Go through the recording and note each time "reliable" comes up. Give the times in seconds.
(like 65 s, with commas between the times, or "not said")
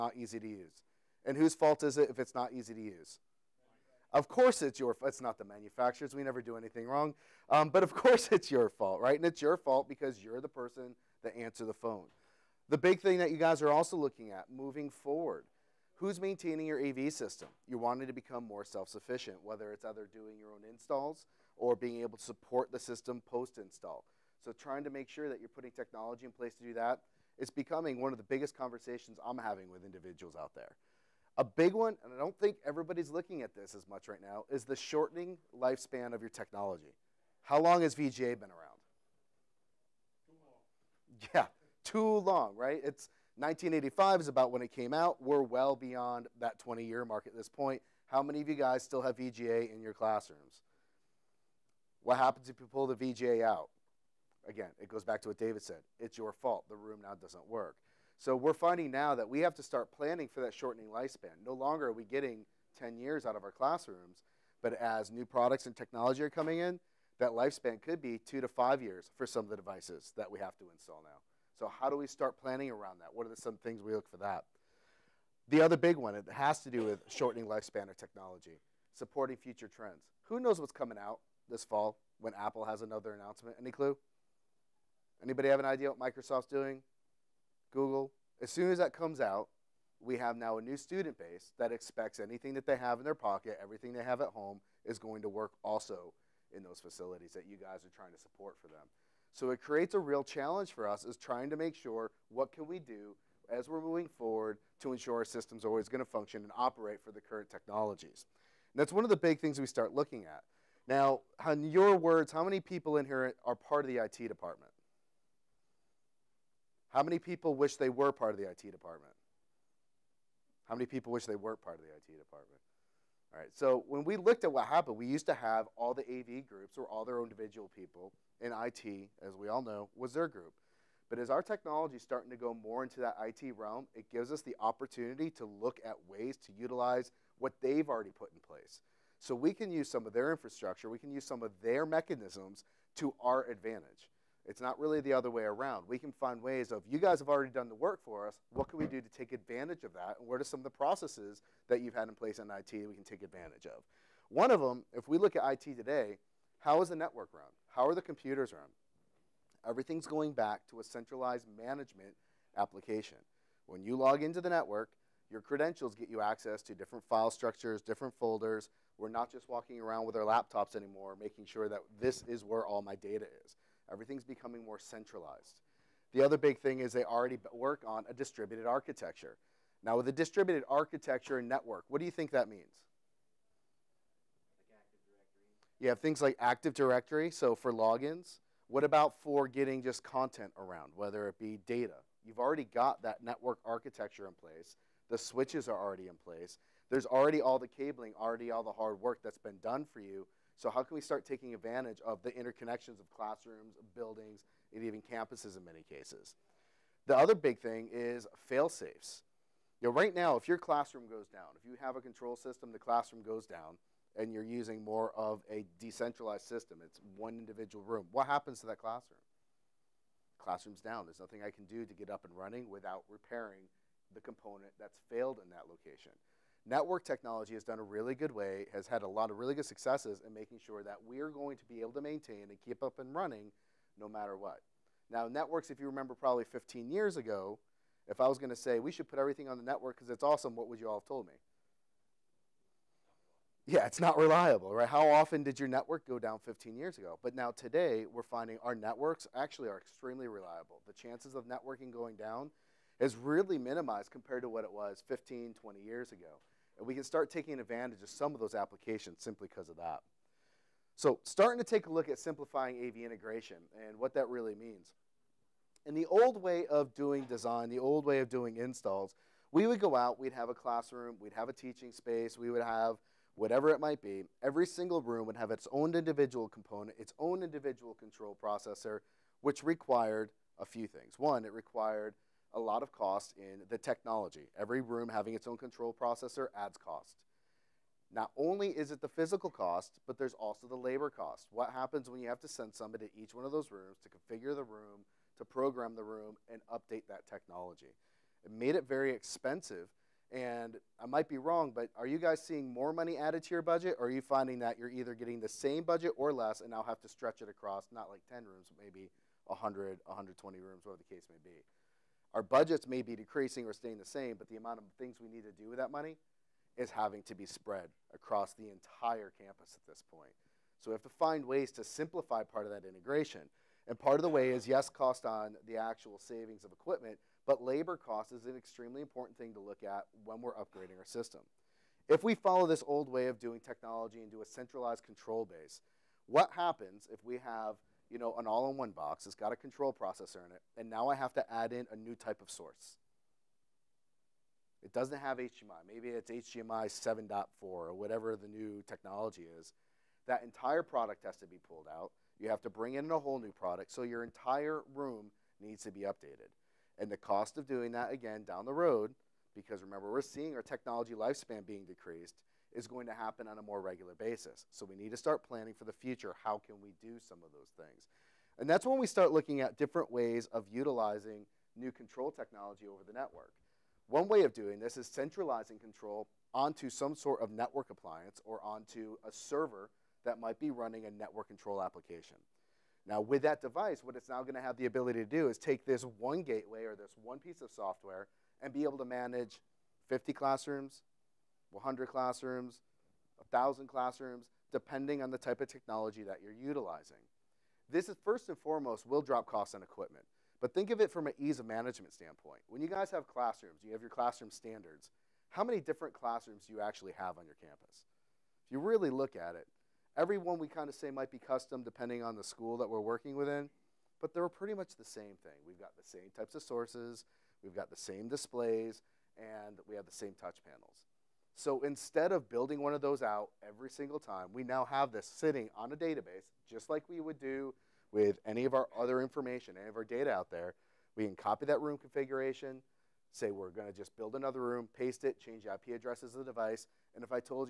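244 s, 250 s.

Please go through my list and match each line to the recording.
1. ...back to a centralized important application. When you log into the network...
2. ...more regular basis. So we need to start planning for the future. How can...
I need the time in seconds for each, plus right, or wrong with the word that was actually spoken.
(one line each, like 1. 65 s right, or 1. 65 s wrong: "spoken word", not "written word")
1. 160 s wrong: "management", not "important"
2. 363 s right.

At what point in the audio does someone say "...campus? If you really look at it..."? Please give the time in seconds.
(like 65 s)
407 s.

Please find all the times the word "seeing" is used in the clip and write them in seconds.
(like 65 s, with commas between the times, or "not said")
302 s, 360 s.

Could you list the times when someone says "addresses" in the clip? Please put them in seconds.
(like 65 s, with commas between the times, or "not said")
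435 s.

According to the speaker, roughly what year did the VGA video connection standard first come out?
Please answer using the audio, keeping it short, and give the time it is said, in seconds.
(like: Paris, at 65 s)
1985, at 43 s.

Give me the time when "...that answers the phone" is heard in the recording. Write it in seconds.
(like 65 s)
11 s.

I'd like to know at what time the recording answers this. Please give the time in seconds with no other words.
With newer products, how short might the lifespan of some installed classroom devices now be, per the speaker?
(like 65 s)
68 s.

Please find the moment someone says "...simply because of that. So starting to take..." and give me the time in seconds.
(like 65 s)
259 s.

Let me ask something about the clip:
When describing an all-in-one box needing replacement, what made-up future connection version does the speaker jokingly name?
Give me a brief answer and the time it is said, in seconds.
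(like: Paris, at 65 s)
HDMI 7.4, at 346 s.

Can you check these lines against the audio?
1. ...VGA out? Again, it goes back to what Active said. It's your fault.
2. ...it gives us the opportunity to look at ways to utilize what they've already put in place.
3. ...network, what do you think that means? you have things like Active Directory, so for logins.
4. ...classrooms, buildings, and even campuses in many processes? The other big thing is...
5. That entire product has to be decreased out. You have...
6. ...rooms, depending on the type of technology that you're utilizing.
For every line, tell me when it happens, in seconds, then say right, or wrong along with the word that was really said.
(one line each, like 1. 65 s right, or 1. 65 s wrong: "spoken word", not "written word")
1. 52 s wrong: "David", not "Active"
2. 133 s right
3. 181 s right
4. 203 s wrong: "cases", not "processes"
5. 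350 s wrong: "pulled", not "decreased"
6. 393 s wrong: "classrooms", not "rooms".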